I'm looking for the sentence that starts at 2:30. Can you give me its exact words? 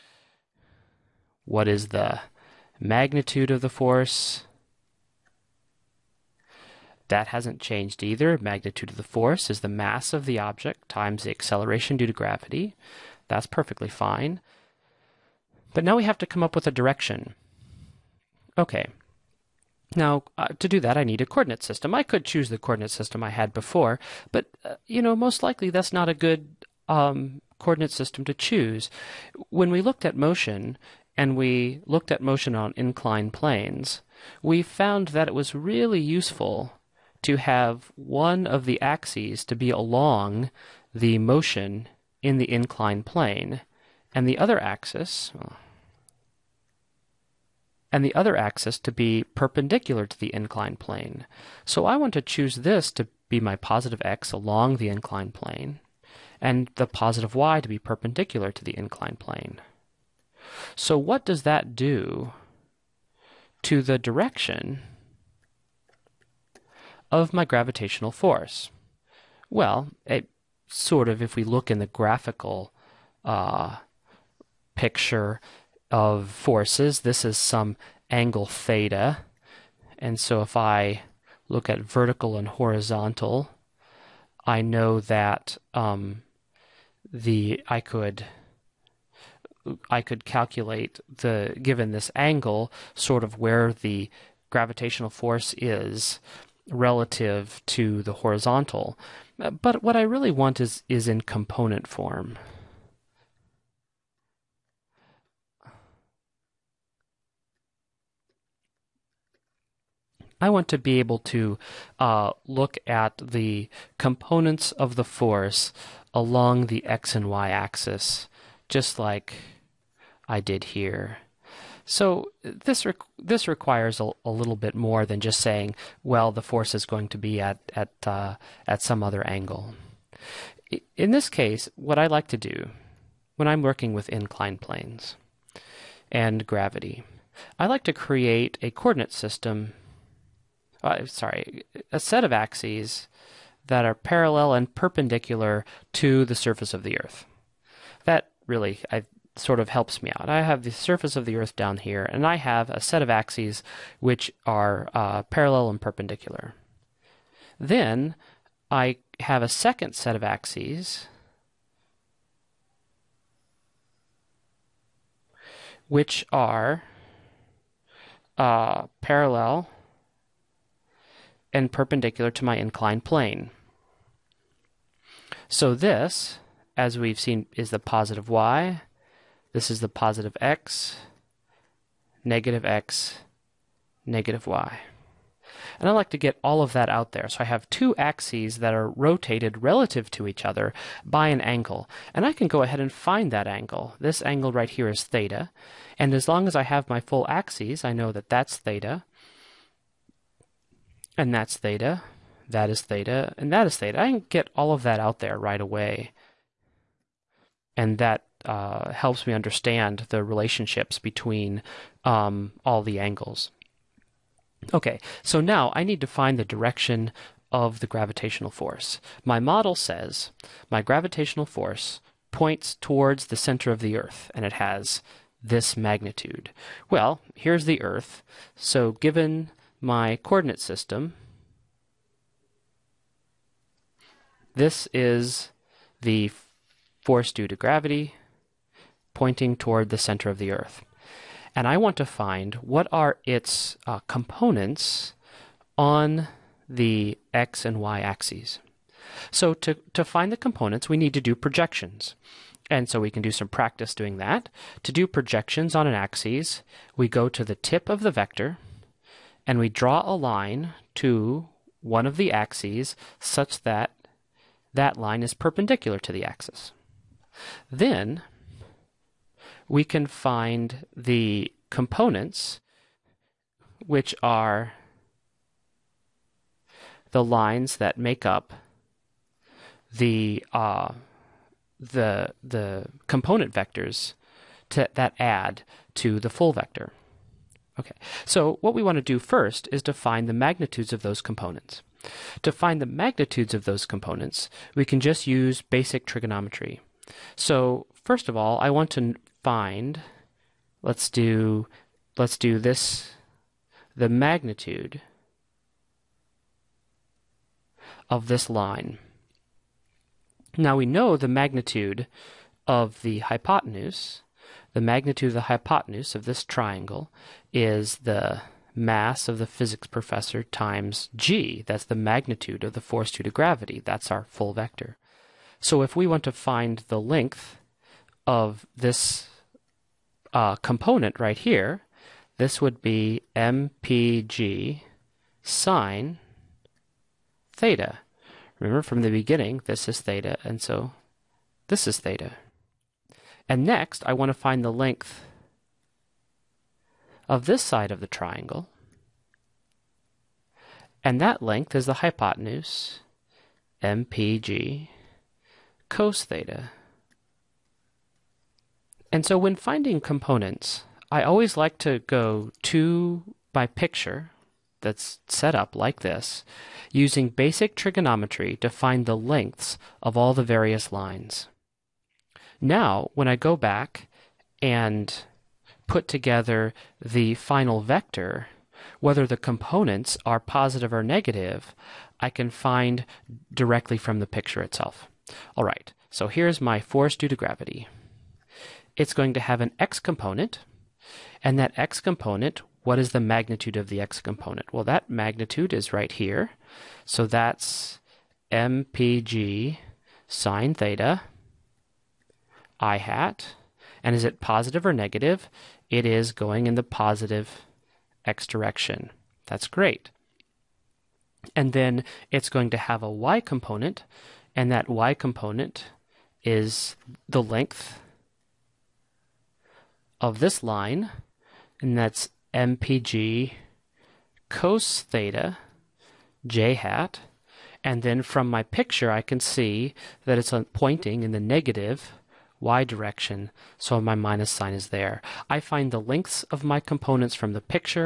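I have the surface of the Earth down here, and I have a set of axes which are uh, parallel and perpendicular.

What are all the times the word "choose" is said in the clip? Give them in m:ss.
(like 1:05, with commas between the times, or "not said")
0:22, 0:28, 0:52.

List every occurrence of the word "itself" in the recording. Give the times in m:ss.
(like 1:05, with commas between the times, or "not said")
6:24.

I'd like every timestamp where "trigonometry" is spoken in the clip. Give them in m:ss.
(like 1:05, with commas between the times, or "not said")
4:56, 6:07.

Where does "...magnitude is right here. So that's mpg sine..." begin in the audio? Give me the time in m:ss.
6:35.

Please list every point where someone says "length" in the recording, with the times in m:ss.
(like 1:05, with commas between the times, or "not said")
5:26, 5:44, 5:51, 6:09, 6:57, 7:15.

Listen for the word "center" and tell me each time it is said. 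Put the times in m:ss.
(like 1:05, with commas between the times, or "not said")
3:43, 3:59.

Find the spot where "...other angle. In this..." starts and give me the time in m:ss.
2:09.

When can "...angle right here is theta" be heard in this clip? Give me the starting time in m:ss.
3:14.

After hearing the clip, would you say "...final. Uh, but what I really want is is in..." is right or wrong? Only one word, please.
wrong.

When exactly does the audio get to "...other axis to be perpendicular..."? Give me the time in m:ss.
0:48.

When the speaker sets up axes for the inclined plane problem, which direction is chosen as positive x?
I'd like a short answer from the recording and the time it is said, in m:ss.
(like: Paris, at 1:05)
Along the inclined plane, at 0:53.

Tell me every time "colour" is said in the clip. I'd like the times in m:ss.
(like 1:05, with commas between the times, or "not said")
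not said.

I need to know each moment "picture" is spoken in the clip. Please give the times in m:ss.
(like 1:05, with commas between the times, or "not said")
1:14, 6:03, 6:24, 7:08.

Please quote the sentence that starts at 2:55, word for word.
So this as we've seen, is the positive y.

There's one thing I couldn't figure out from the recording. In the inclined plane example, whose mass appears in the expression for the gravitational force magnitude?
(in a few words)
The physics professor.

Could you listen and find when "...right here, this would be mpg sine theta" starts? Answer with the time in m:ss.
5:31.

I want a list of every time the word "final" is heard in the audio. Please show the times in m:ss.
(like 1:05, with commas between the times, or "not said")
6:17.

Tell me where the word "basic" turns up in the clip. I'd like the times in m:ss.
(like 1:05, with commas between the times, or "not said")
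4:55, 6:07.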